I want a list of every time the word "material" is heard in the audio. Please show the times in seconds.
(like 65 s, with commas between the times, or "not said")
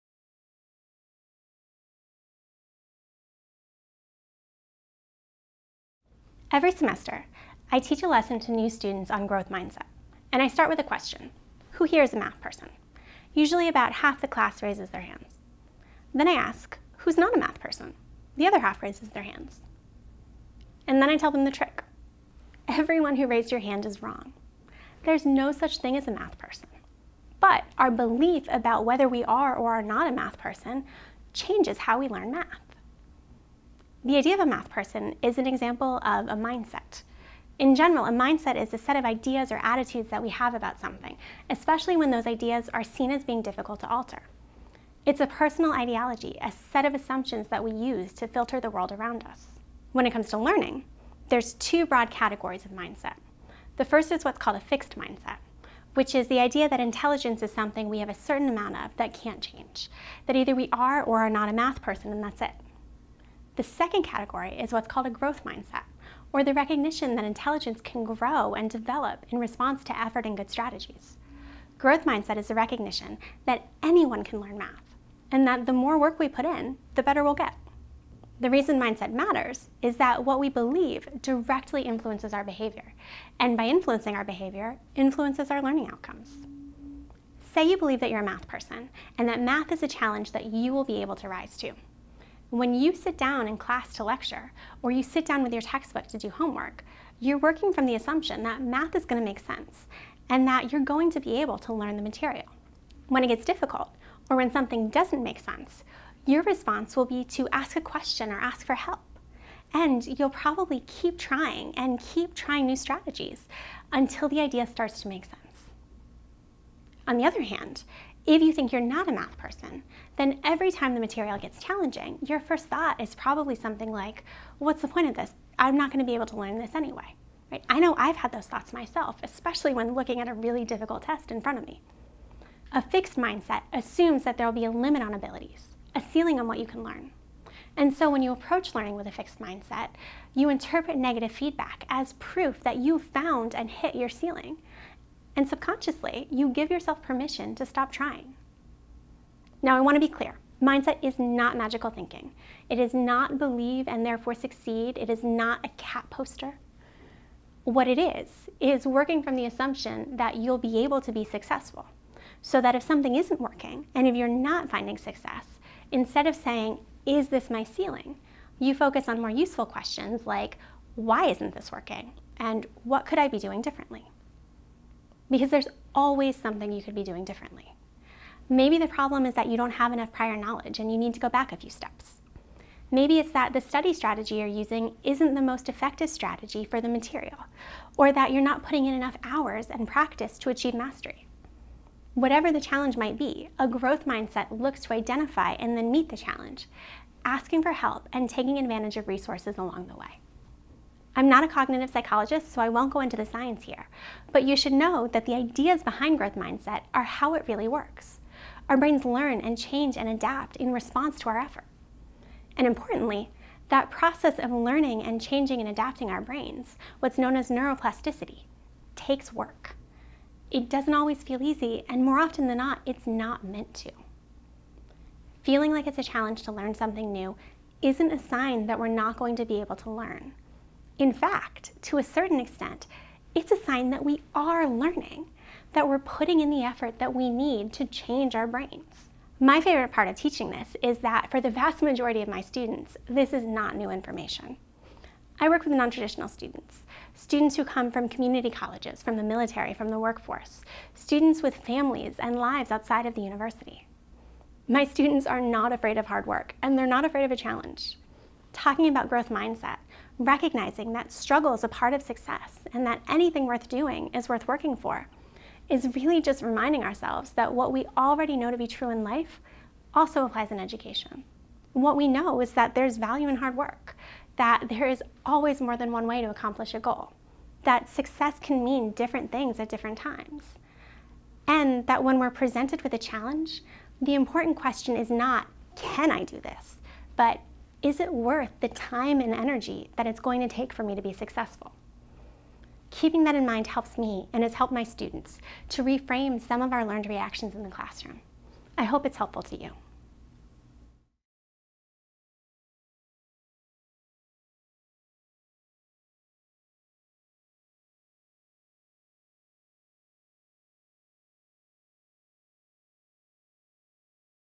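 102 s, 120 s, 186 s.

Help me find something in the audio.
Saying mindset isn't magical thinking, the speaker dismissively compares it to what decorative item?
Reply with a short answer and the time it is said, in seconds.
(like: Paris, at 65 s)
cat poster, at 155 s.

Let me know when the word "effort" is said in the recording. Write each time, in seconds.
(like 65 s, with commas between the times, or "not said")
69 s, 211 s, 236 s.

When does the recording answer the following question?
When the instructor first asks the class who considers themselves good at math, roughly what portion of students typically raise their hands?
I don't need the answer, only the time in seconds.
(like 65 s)
13 s.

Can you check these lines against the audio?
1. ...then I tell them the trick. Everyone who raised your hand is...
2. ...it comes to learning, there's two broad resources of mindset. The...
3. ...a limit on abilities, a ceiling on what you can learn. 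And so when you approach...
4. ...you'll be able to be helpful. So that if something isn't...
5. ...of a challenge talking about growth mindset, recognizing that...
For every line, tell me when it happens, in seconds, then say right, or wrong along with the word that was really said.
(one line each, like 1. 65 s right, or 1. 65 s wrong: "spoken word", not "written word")
1. 21 s right
2. 50 s wrong: "categories", not "resources"
3. 134 s right
4. 160 s wrong: "successful", not "helpful"
5. 257 s right.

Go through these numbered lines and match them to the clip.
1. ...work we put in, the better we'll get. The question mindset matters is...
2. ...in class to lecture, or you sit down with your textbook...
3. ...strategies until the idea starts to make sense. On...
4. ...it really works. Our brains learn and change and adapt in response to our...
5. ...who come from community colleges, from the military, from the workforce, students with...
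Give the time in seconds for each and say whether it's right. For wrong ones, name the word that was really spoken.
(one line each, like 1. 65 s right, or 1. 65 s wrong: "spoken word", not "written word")
1. 75 s wrong: "reason", not "question"
2. 93 s right
3. 112 s right
4. 207 s right
5. 247 s right.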